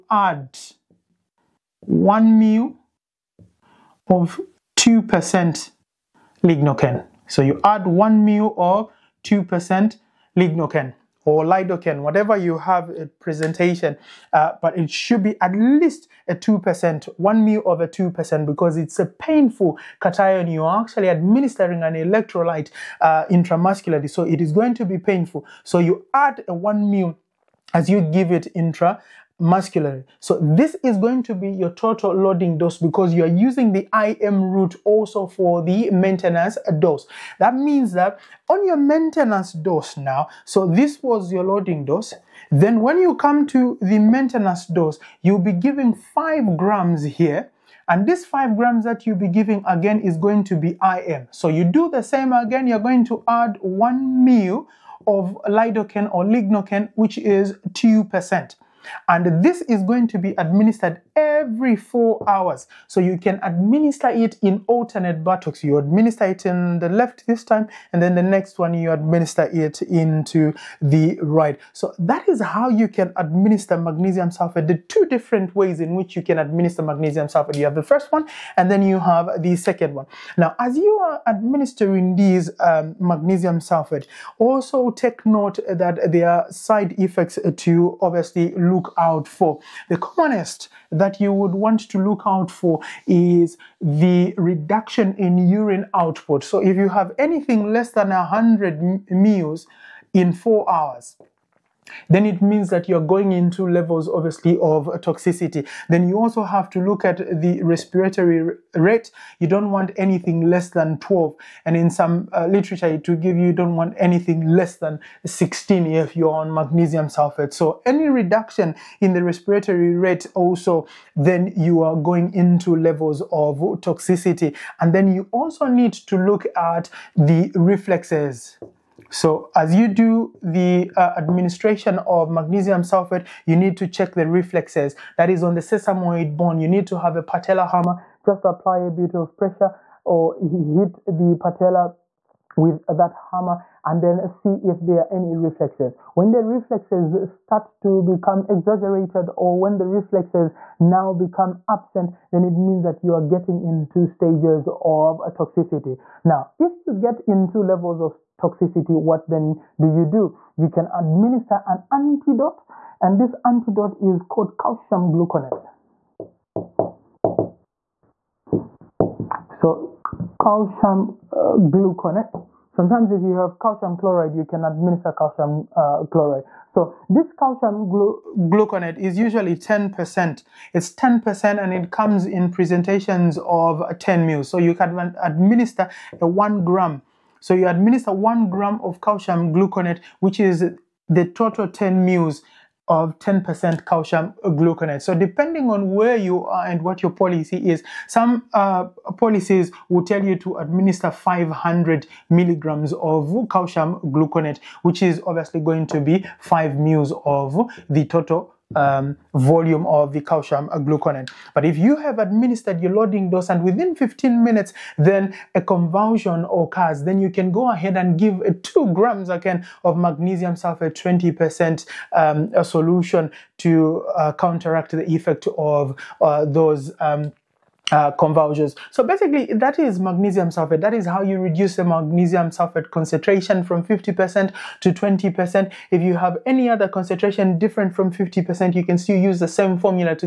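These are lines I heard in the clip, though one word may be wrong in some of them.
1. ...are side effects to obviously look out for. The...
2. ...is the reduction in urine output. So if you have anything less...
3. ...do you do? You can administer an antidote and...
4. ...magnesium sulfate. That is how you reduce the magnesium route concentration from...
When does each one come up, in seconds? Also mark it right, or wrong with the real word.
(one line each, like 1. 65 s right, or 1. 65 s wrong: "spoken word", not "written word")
1. 86 s right
2. 93 s right
3. 159 s right
4. 229 s wrong: "sulfate", not "route".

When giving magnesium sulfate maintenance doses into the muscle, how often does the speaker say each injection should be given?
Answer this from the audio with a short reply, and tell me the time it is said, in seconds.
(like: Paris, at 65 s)
every four hours, at 61 s.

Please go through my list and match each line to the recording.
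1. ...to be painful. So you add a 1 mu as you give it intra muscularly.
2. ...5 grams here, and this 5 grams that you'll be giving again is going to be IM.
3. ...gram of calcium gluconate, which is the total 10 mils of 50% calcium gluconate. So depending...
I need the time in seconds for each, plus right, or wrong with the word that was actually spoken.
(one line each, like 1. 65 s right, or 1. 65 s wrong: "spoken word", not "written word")
1. 24 s right
2. 45 s right
3. 188 s wrong: "10", not "50".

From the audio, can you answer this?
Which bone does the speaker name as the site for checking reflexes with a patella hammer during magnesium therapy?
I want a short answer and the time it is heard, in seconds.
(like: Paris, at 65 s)
sesamoid bone, at 135 s.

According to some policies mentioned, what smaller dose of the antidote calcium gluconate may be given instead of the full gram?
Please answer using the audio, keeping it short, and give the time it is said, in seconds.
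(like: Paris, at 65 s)
500 mg, at 201 s.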